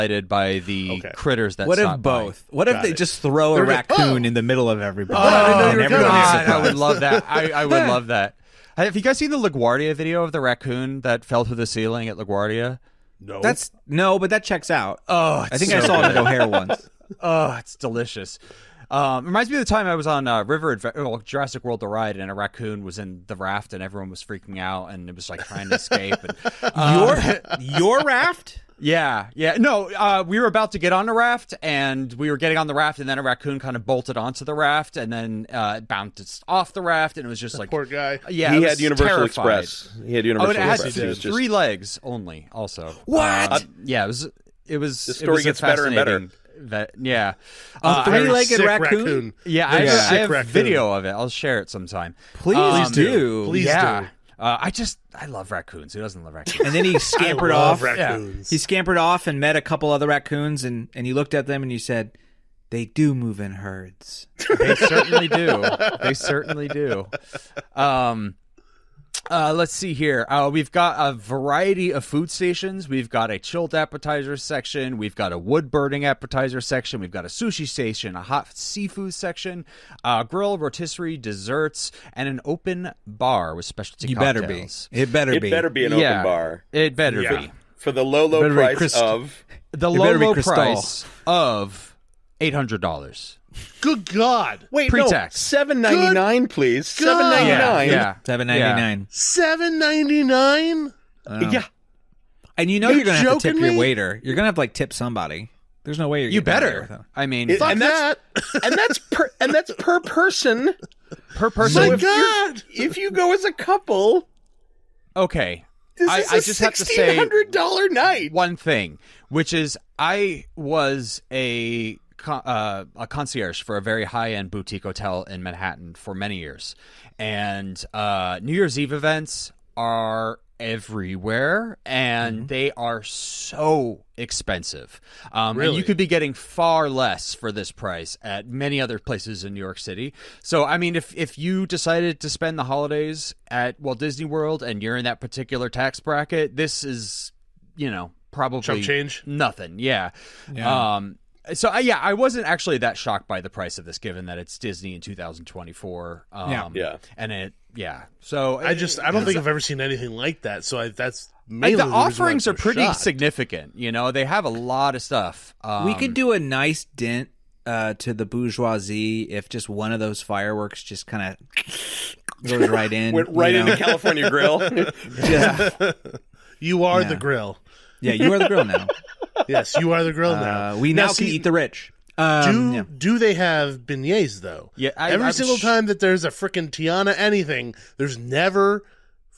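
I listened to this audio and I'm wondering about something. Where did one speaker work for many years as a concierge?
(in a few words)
Boutique hotel in Manhattan.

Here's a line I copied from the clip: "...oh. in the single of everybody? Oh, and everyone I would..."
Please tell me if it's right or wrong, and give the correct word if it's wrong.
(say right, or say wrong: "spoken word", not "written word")
wrong: "middle", not "single".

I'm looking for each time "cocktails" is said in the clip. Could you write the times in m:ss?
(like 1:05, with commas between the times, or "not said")
1:24.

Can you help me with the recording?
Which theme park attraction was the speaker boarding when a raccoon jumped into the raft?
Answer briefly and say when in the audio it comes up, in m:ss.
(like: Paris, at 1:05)
Jurassic World: The Ride, at 0:21.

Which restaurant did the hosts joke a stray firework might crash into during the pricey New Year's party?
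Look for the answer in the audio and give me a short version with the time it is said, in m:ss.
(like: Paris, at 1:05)
California Grill, at 2:53.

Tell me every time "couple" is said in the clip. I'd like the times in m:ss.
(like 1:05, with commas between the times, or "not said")
0:59, 1:53.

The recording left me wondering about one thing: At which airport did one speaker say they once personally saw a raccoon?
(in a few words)
O'Hare.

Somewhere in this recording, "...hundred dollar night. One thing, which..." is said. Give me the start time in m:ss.
1:57.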